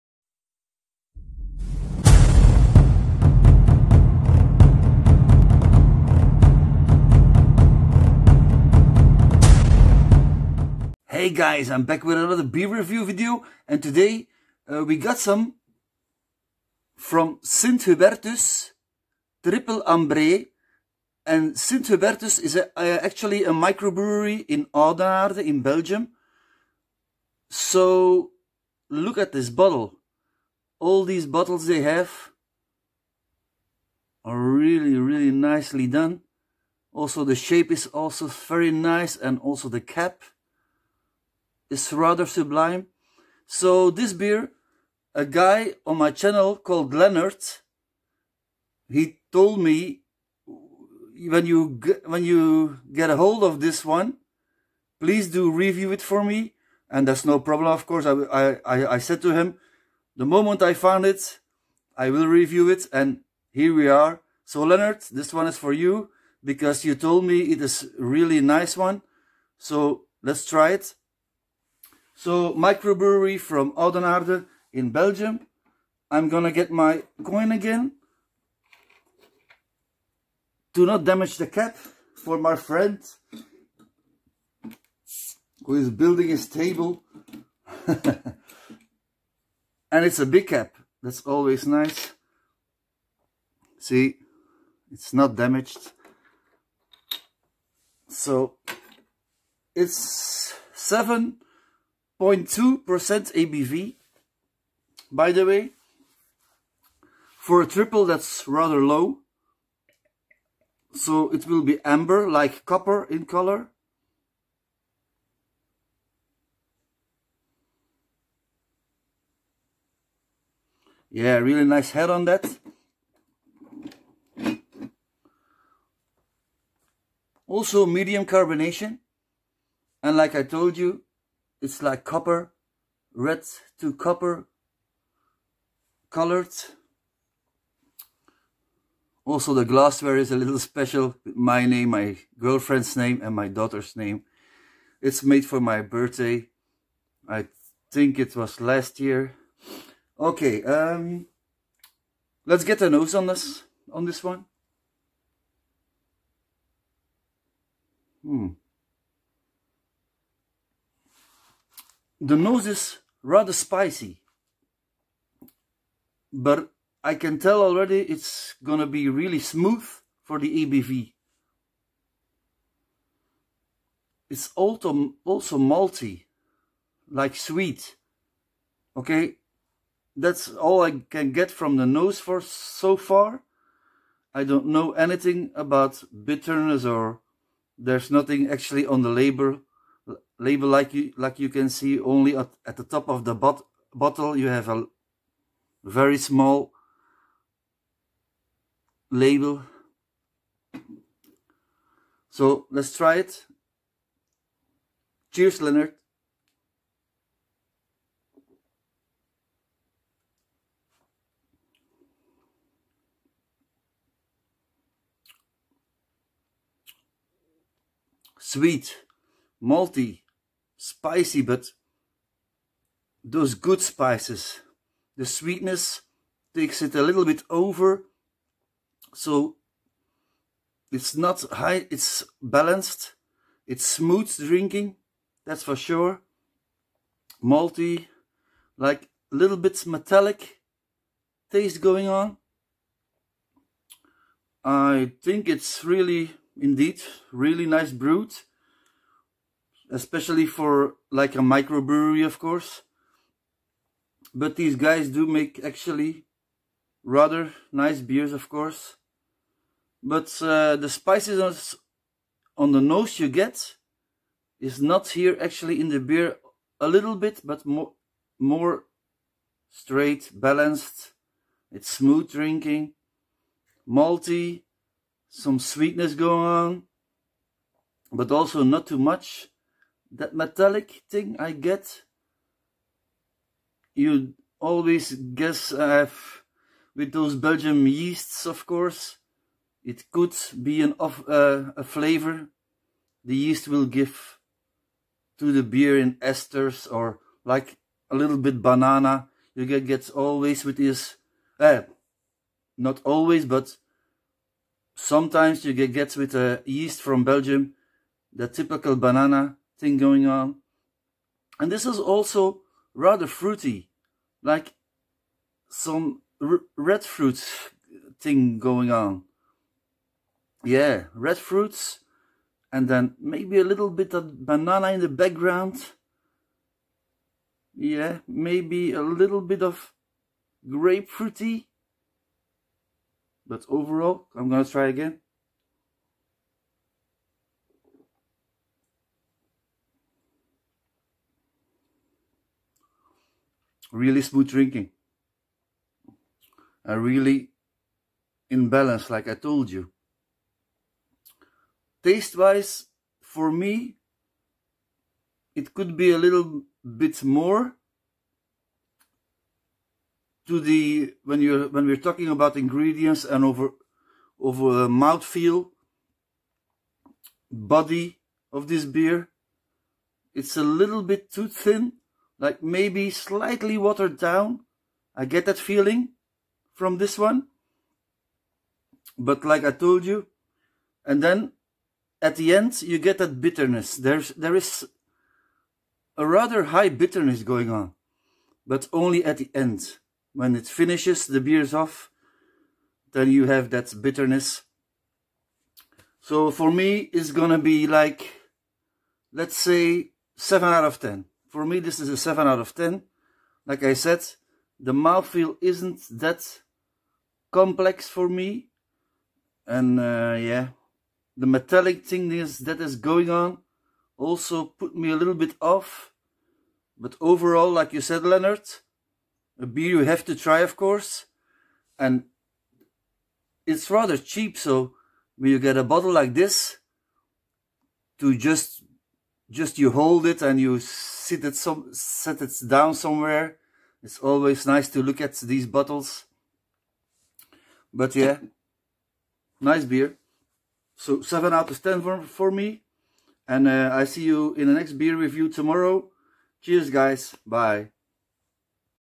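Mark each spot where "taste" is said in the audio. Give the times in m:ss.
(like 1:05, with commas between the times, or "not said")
4:01, 5:52.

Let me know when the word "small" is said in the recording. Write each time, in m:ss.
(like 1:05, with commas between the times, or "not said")
3:16.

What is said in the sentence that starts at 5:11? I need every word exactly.
And this is also rather fruity, like some red fruit thing going on.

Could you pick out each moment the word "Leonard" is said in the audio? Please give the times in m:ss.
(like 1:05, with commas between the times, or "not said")
0:46, 1:04, 3:25, 6:58.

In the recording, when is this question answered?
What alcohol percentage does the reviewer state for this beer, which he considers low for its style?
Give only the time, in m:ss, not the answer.
1:40.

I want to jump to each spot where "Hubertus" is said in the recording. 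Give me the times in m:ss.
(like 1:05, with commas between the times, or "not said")
0:17, 0:21.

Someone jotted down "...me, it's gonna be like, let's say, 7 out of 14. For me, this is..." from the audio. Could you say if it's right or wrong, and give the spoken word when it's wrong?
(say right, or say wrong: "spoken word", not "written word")
wrong: "10", not "14".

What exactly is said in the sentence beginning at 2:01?
Yeah, really nice head on that.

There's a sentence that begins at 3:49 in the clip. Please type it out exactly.
So it's not high, it's balanced.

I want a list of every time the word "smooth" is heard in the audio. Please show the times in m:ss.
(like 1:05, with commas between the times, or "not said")
2:49, 3:53, 4:31, 5:44.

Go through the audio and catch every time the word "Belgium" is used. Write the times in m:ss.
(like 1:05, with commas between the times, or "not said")
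0:25, 1:14, 4:47, 5:07.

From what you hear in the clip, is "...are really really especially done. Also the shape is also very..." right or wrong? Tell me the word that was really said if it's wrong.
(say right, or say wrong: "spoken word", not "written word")
wrong: "nicely", not "especially".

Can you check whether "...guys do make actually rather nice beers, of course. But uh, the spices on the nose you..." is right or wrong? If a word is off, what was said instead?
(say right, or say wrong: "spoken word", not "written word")
right.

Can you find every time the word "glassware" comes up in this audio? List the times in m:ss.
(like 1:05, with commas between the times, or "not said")
2:19.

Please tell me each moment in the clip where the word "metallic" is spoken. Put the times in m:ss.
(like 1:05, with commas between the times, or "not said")
3:59, 4:40, 6:51.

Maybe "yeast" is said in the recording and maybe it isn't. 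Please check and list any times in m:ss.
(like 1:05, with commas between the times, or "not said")
4:47, 4:53, 5:06.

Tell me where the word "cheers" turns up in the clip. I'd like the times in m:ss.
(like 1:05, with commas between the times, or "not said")
3:25, 7:26.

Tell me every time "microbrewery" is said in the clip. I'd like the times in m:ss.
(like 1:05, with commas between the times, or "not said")
0:23, 1:12, 4:11.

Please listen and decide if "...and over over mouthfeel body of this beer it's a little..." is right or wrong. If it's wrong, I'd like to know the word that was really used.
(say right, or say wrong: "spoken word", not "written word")
right.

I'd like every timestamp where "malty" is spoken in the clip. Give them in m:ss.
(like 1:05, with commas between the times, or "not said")
2:55, 3:39, 3:57, 4:33.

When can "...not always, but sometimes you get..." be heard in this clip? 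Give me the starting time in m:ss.
5:02.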